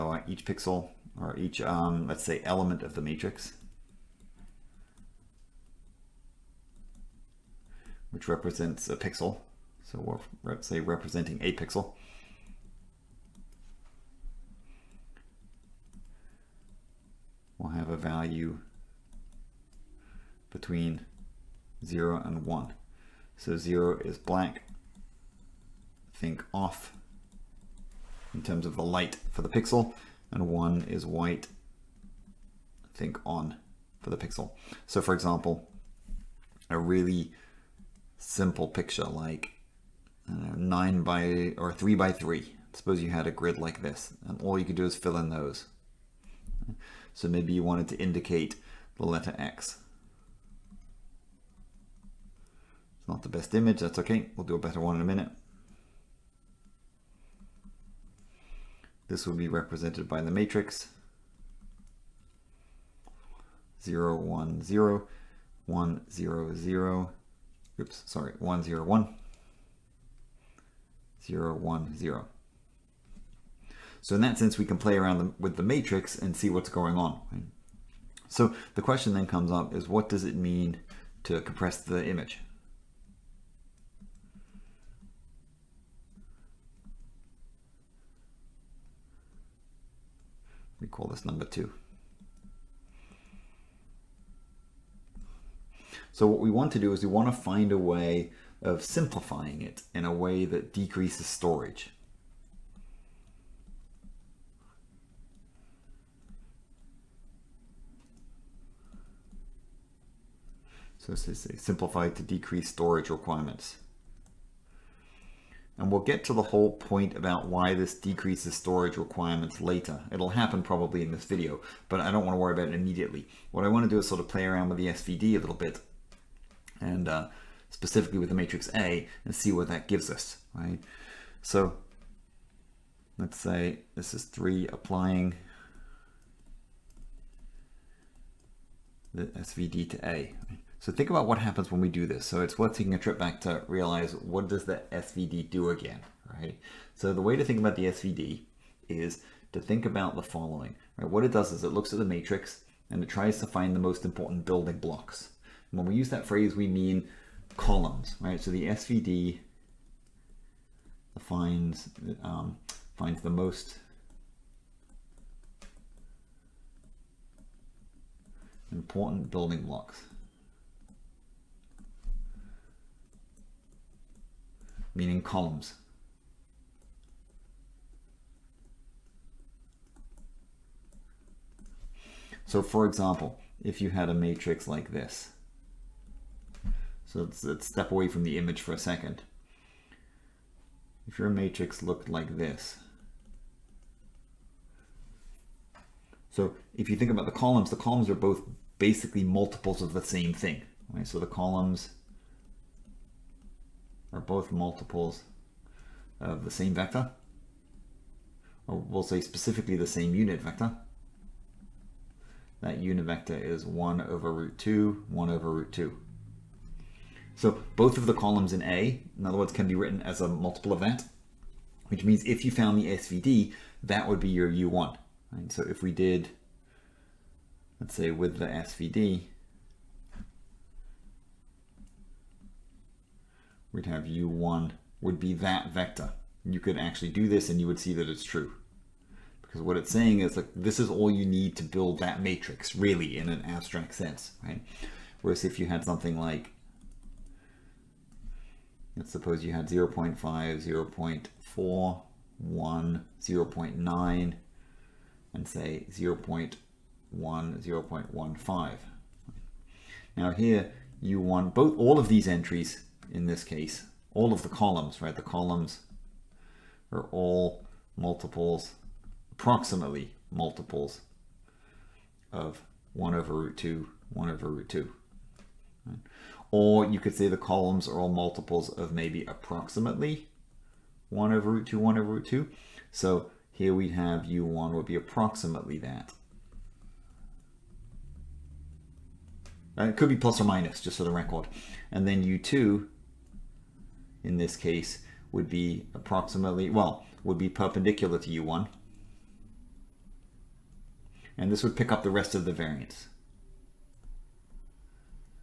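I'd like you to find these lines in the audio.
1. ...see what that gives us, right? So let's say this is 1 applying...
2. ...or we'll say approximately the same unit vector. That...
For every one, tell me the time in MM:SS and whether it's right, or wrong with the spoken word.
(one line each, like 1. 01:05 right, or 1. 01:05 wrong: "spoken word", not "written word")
1. 02:09 wrong: "3", not "1"
2. 03:28 wrong: "specifically", not "approximately".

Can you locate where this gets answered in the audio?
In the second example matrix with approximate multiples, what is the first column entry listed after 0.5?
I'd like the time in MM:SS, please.
04:10.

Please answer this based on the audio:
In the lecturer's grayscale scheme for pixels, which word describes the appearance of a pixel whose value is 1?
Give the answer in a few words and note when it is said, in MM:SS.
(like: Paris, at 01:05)
White, at 00:30.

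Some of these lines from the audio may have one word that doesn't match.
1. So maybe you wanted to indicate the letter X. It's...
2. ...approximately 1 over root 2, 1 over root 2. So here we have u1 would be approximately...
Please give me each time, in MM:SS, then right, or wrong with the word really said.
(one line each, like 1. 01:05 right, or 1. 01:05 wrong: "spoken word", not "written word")
1. 00:47 right
2. 04:39 right.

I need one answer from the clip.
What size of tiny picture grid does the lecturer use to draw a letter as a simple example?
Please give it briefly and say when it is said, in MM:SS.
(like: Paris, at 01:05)
3 by 3, at 00:41.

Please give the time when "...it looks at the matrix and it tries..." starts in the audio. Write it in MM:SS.
02:31.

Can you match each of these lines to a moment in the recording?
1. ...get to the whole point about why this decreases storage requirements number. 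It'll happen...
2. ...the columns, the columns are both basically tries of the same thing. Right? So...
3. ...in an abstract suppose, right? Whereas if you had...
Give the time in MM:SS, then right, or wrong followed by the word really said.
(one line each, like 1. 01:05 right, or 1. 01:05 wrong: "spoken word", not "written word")
1. 01:56 wrong: "later", not "number"
2. 03:17 wrong: "multiples", not "tries"
3. 04:03 wrong: "sense", not "suppose".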